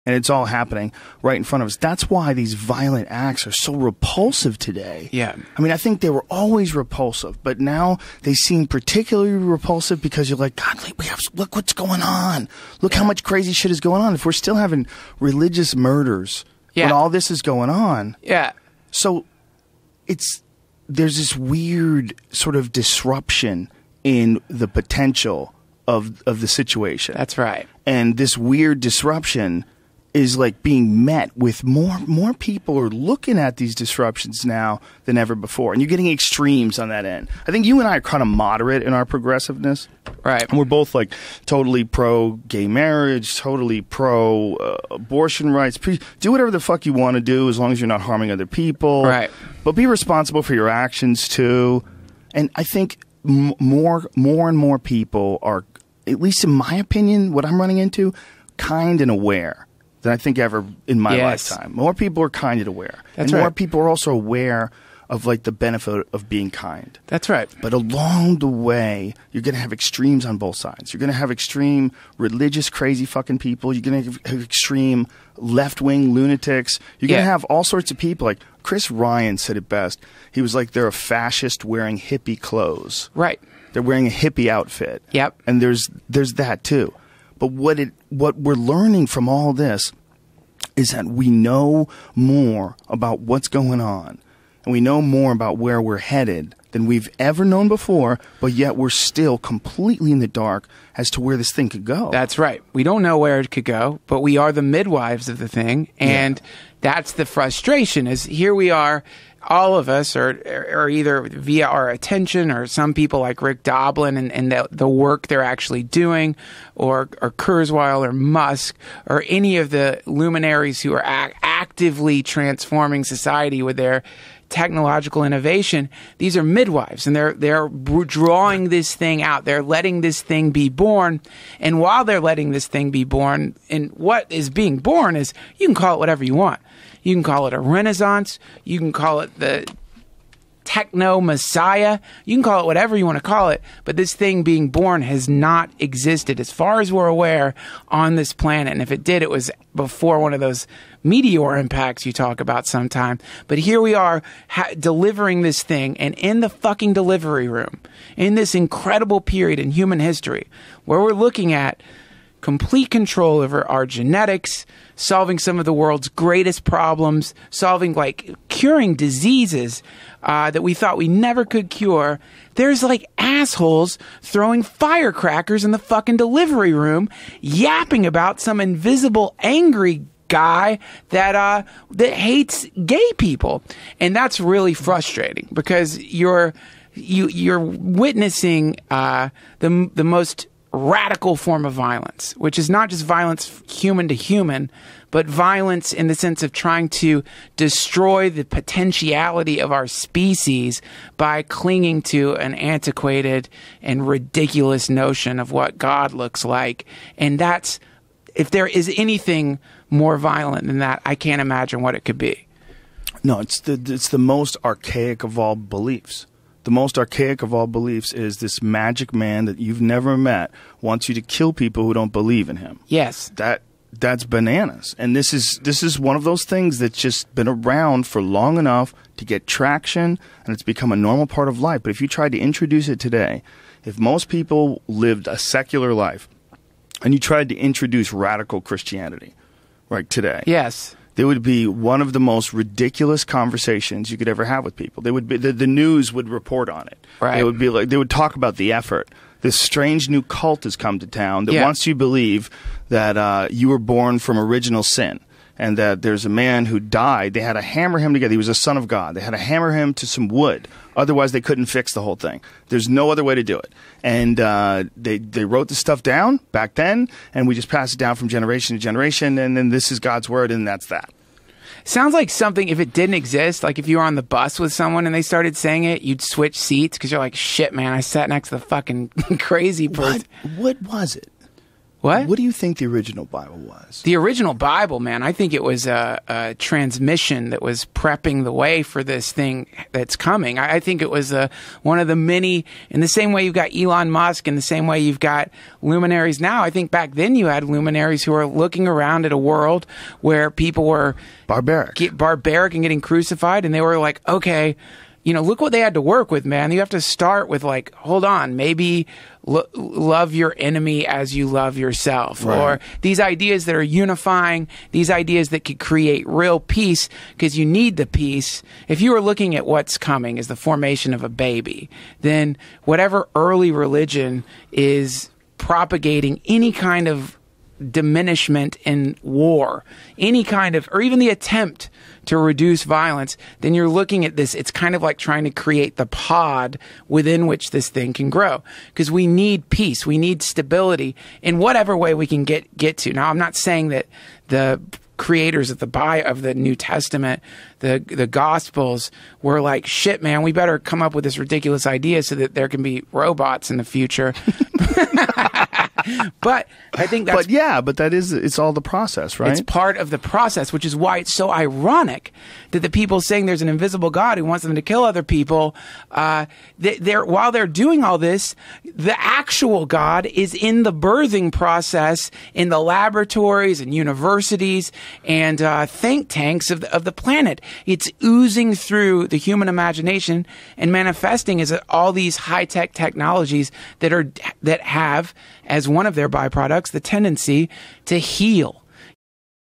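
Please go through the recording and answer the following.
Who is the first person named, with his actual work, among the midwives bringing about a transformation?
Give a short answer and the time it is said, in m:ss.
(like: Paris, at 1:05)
Rick Doblin, at 1:53.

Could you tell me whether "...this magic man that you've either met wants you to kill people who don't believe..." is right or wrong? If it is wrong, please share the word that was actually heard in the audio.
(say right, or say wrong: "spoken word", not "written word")
wrong: "never", not "either".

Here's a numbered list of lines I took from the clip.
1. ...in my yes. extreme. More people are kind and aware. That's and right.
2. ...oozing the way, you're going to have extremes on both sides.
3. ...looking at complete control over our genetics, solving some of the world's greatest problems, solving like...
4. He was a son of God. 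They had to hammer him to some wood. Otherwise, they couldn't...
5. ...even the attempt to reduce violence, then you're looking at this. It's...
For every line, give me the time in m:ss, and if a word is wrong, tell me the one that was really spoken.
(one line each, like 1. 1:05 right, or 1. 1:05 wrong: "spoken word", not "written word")
1. 1:00 wrong: "lifetime", not "extreme"
2. 1:07 wrong: "along", not "oozing"
3. 2:41 right
4. 4:18 right
5. 5:31 right.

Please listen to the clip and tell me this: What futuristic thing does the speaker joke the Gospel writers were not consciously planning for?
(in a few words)
Robots.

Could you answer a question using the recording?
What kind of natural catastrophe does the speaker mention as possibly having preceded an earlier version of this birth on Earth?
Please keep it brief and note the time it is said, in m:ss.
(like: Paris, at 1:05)
Meteor impacts, at 2:31.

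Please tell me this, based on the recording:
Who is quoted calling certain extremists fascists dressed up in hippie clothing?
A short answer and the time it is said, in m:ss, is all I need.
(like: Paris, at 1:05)
Chris Ryan, at 1:18.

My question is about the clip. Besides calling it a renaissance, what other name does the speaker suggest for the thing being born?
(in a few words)
The techno messiah.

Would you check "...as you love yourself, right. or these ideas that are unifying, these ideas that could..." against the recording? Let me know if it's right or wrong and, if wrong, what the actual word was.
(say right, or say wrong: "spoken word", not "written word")
right.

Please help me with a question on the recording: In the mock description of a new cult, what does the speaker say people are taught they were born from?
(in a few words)
Original sin.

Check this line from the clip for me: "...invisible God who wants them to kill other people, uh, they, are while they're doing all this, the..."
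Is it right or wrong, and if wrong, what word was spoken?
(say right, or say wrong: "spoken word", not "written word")
right.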